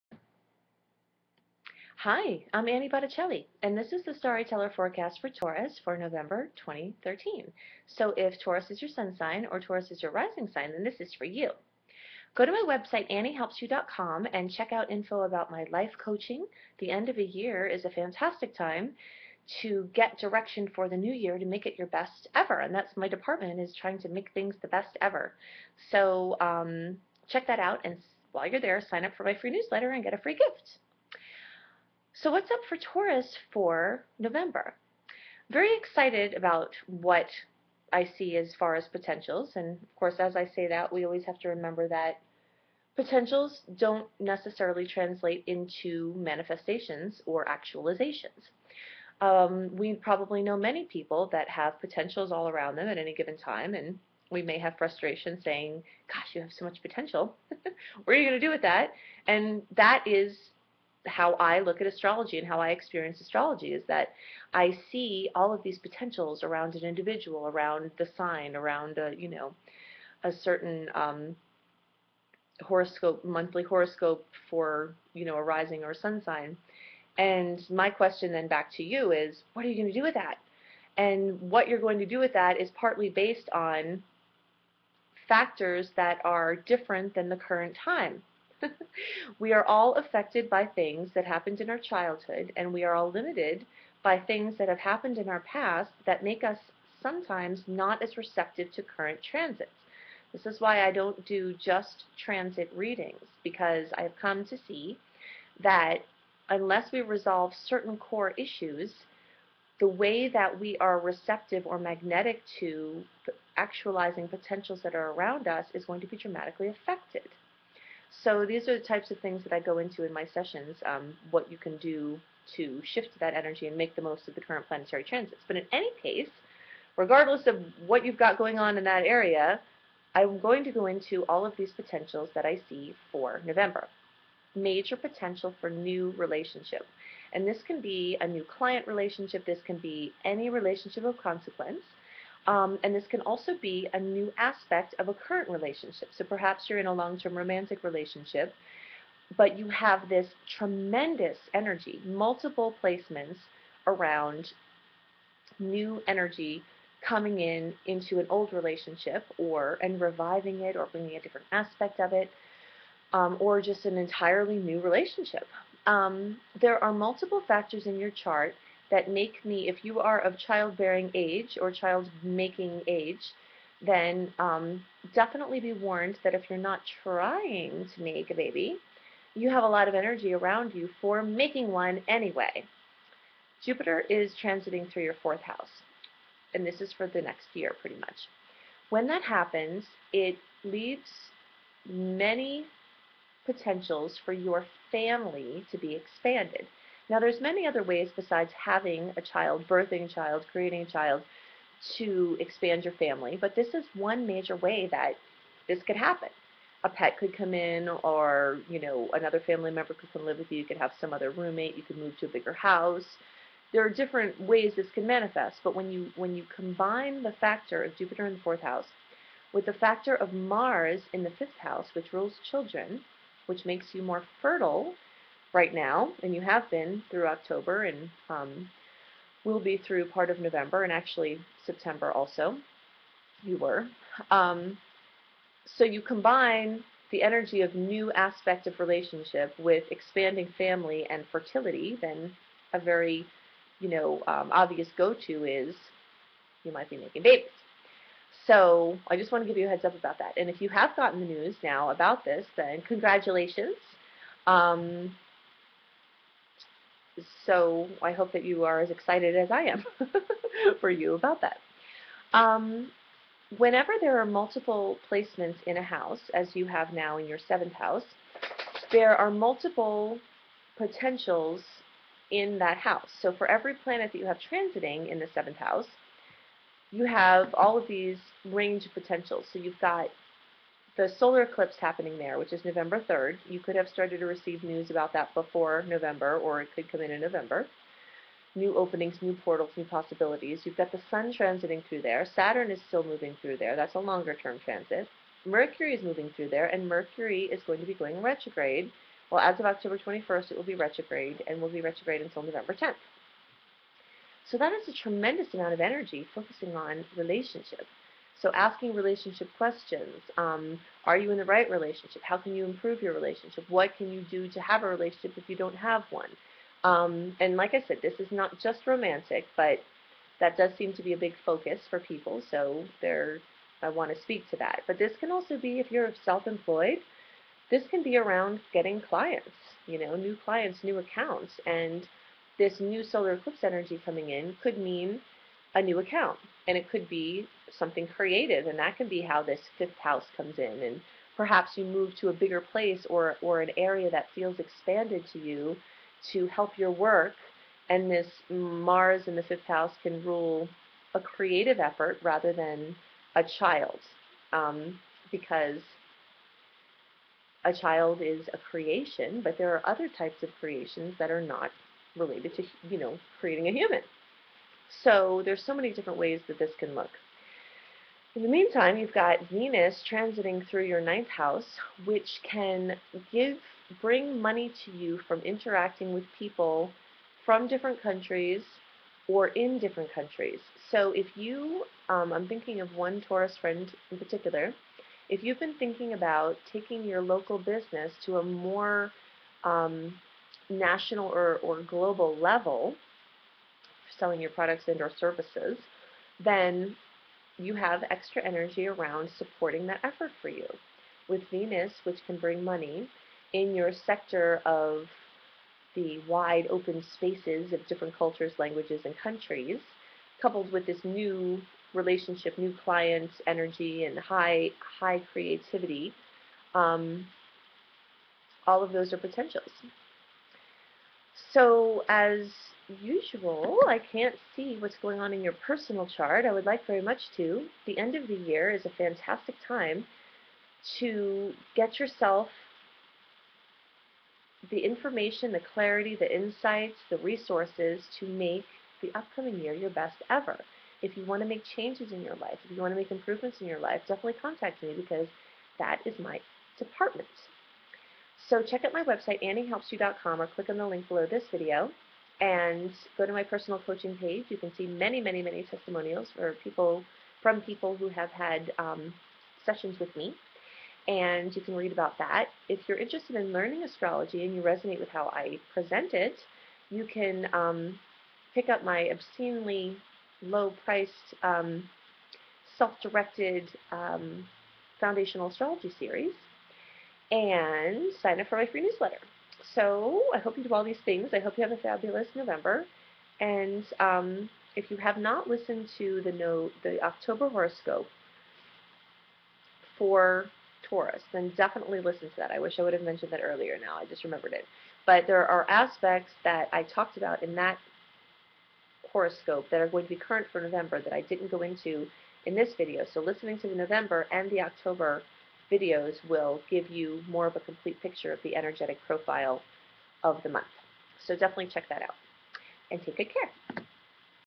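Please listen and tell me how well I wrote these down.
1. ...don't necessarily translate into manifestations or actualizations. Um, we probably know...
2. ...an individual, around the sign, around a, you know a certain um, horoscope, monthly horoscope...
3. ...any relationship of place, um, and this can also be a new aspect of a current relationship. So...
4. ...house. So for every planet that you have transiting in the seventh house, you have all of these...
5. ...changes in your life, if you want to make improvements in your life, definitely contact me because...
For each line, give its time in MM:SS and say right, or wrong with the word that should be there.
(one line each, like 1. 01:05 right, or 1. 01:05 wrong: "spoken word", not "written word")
1. 00:43 right
2. 01:06 right
3. 02:20 wrong: "consequence", not "place"
4. 04:32 right
5. 07:21 right.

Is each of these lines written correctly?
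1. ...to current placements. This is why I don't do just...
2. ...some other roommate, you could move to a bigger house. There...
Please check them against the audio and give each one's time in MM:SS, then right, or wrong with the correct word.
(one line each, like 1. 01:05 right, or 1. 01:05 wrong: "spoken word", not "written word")
1. 01:38 wrong: "transits", not "placements"
2. 03:31 right.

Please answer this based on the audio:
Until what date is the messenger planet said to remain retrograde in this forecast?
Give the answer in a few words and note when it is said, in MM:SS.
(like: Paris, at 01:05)
November 10th, at 05:02.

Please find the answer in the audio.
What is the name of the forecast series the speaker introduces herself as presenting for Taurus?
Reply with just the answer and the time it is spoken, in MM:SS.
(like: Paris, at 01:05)
Starry Teller, at 00:04.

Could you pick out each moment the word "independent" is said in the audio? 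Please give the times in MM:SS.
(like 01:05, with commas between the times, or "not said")
not said.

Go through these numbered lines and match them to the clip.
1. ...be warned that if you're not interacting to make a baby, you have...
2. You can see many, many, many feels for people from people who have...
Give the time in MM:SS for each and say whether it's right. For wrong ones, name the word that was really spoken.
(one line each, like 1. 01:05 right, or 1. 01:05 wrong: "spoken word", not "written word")
1. 02:55 wrong: "trying", not "interacting"
2. 07:34 wrong: "testimonials", not "feels".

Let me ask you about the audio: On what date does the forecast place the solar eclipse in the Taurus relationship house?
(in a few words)
November 3rd.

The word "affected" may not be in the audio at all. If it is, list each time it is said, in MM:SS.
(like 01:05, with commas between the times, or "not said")
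01:29, 01:56.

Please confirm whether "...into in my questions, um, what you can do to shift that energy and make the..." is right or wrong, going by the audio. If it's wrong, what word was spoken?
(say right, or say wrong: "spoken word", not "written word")
wrong: "sessions", not "questions".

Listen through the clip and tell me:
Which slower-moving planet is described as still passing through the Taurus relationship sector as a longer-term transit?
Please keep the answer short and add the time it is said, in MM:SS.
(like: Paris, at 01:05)
Saturn, at 04:52.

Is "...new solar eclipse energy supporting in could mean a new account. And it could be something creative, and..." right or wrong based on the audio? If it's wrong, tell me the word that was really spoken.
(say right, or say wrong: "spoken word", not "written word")
wrong: "coming", not "supporting".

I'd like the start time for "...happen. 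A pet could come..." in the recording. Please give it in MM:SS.
03:25.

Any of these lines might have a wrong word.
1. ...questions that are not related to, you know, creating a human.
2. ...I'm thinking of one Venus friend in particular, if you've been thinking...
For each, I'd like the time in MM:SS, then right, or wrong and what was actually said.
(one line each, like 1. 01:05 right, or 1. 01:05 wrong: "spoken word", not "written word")
1. 06:00 wrong: "creations", not "questions"
2. 06:22 wrong: "Taurus", not "Venus".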